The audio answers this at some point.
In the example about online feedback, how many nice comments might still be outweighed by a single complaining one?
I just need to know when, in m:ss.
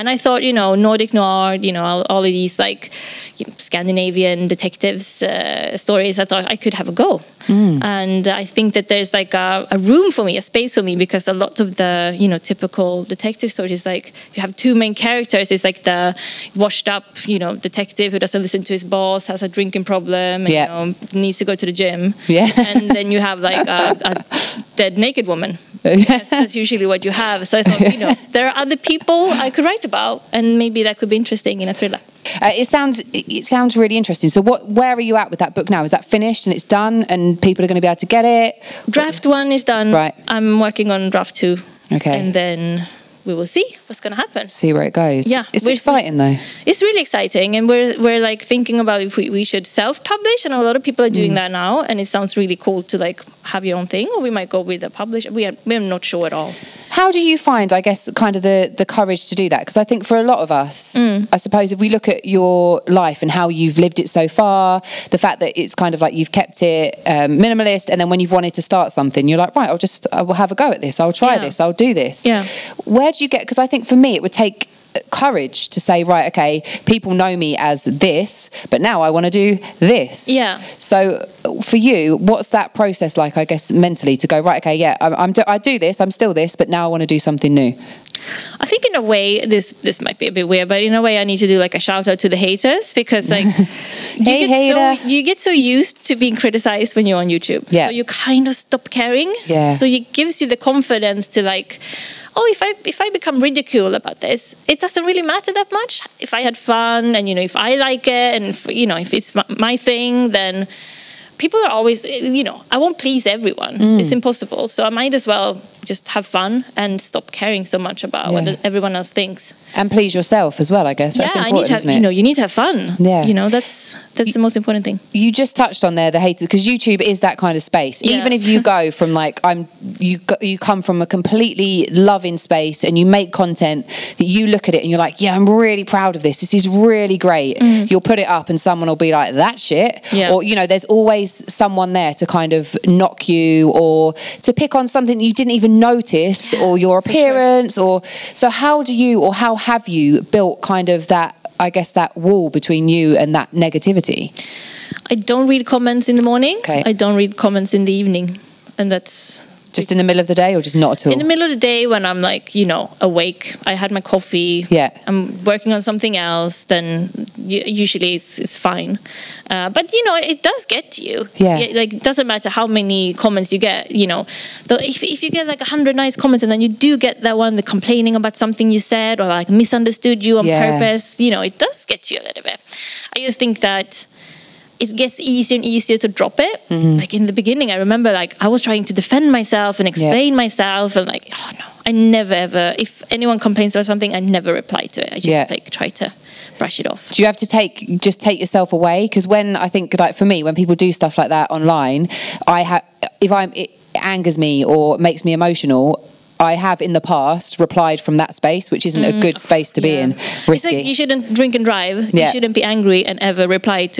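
2:55.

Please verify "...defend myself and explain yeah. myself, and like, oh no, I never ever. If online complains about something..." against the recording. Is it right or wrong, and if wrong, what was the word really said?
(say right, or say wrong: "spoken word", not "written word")
wrong: "anyone", not "online".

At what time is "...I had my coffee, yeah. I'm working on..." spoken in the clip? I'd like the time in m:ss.
2:43.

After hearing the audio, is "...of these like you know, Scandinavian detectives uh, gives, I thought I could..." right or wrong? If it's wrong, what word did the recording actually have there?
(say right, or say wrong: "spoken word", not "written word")
wrong: "stories", not "gives".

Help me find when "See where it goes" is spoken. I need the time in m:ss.
0:44.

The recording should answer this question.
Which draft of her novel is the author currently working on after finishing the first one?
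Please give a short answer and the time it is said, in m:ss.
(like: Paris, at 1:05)
Draft two, at 0:41.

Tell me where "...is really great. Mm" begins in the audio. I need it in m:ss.
2:16.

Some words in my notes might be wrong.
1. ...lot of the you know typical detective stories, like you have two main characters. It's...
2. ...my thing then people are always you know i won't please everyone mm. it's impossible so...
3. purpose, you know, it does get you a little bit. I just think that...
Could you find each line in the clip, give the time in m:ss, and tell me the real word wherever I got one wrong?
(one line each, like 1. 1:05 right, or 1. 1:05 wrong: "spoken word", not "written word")
1. 0:11 right
2. 1:49 right
3. 3:00 right.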